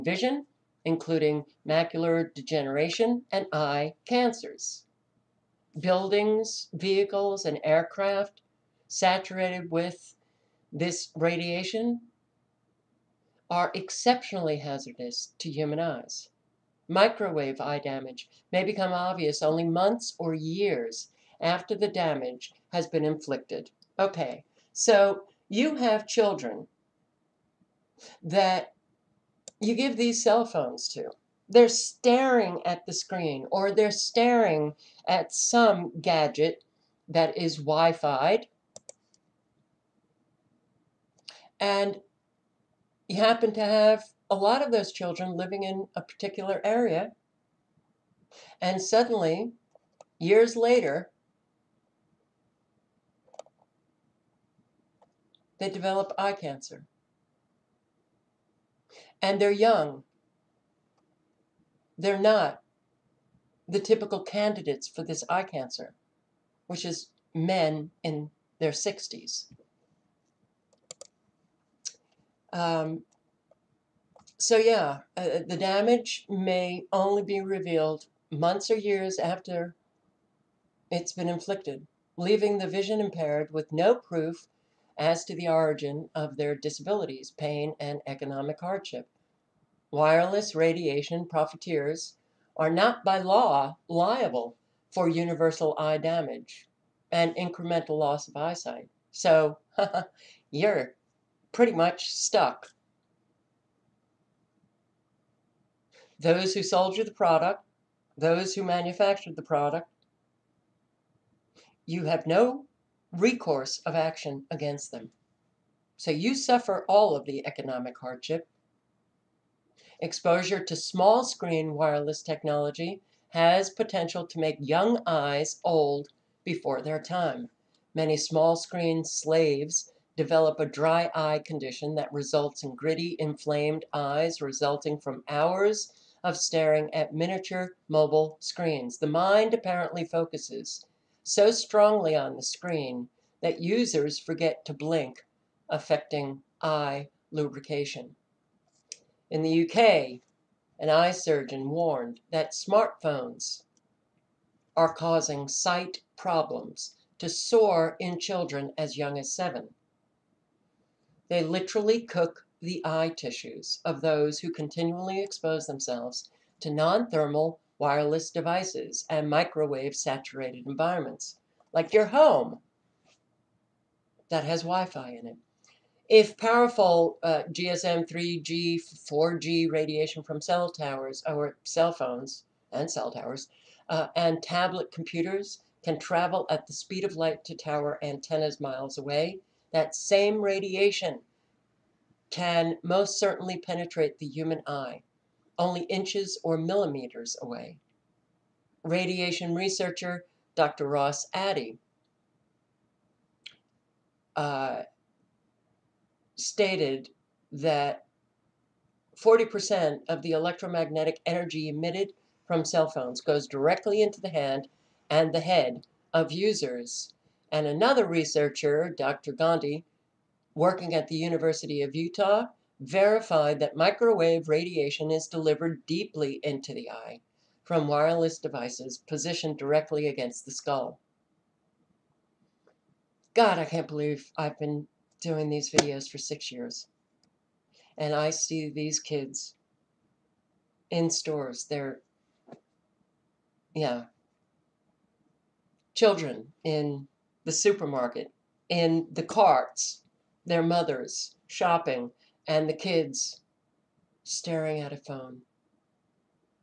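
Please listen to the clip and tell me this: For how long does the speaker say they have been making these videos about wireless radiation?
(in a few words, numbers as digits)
6 years.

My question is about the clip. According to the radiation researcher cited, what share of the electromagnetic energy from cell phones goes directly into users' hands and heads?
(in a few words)
40%.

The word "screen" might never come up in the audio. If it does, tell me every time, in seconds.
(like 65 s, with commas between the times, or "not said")
32 s, 121 s, 128 s, 138 s, 142 s.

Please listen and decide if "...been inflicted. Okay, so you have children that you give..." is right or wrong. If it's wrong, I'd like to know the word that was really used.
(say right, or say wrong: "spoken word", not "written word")
right.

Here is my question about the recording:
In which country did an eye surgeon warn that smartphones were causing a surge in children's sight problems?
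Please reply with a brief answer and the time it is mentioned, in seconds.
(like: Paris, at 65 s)
UK, at 149 s.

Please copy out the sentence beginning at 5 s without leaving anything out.
Buildings, vehicles, and aircraft saturated with this radiation are exceptionally hazardous to human eyes.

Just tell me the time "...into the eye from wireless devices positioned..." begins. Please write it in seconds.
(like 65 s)
226 s.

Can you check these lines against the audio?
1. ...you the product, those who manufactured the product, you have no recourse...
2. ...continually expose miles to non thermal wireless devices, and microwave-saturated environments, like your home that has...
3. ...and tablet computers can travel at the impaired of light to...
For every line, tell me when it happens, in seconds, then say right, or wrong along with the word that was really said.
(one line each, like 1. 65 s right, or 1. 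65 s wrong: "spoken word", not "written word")
1. 106 s right
2. 164 s wrong: "themselves", not "miles"
3. 184 s wrong: "speed", not "impaired".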